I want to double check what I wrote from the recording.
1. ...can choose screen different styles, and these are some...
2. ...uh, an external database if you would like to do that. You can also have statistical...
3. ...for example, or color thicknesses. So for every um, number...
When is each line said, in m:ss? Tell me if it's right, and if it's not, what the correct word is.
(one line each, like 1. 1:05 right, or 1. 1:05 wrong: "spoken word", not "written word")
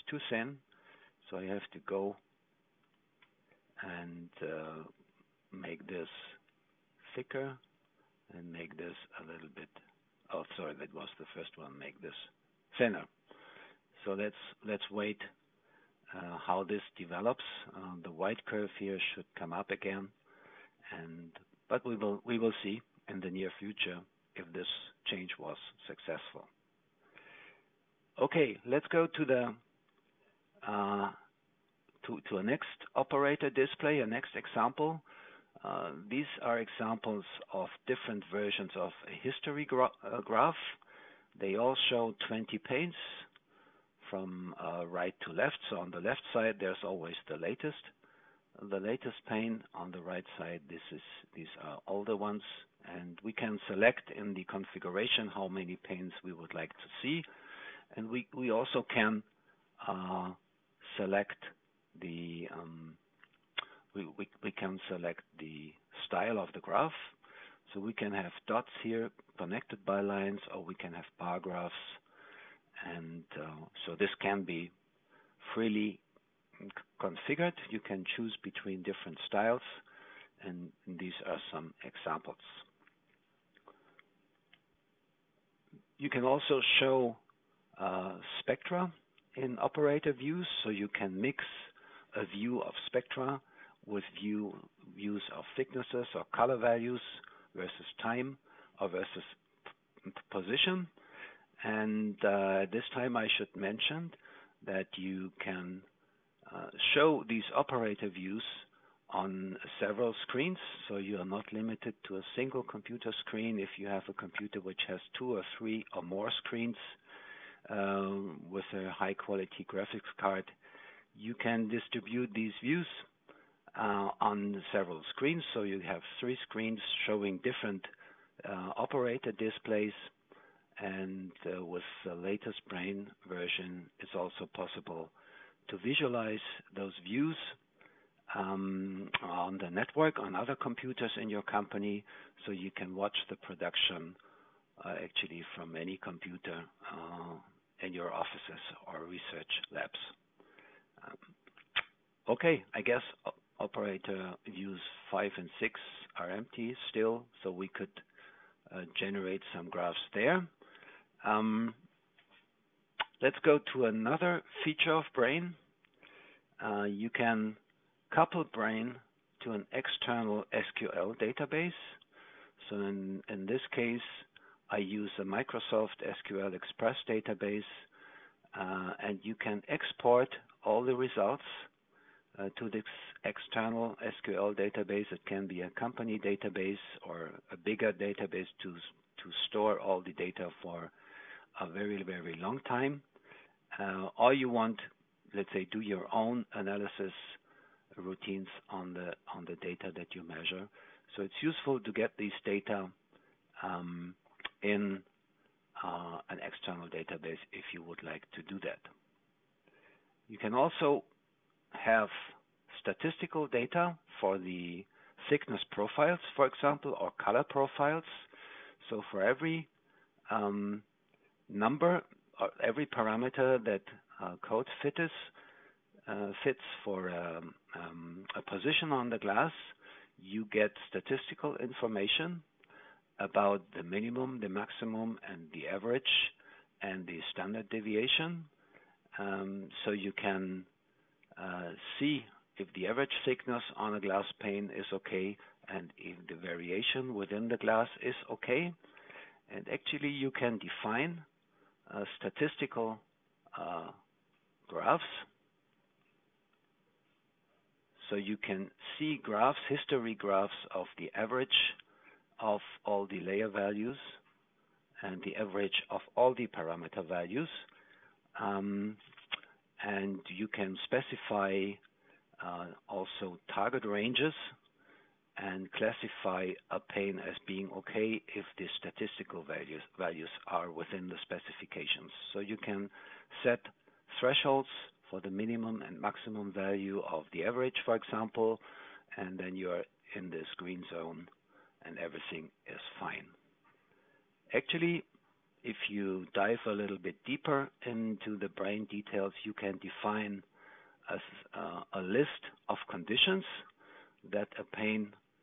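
1. 1:17 wrong: "between", not "screen"
2. 3:25 right
3. 3:36 wrong: "profiles", not "thicknesses".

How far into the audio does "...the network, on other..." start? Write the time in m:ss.
2:19.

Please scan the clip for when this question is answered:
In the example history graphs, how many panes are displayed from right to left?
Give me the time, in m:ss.
0:42.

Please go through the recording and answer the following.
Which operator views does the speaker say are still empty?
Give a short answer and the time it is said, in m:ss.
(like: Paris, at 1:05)
5 and 6, at 2:35.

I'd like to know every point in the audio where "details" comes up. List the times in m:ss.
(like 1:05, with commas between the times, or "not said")
4:58.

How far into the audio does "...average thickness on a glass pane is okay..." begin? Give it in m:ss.
4:02.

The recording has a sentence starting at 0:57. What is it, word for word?
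And We also can um, select the style of the graph.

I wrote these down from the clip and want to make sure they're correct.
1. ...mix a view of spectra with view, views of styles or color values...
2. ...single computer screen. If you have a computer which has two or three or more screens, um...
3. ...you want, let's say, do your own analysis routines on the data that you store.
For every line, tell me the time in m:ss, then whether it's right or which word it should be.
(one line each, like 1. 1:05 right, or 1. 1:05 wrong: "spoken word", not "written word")
1. 1:31 wrong: "thicknesses", not "styles"
2. 1:52 right
3. 3:14 wrong: "measure", not "store".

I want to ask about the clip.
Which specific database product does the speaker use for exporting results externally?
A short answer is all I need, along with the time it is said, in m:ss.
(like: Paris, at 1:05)
Microsoft SQL Express, at 2:55.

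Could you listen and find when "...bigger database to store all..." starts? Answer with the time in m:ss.
3:07.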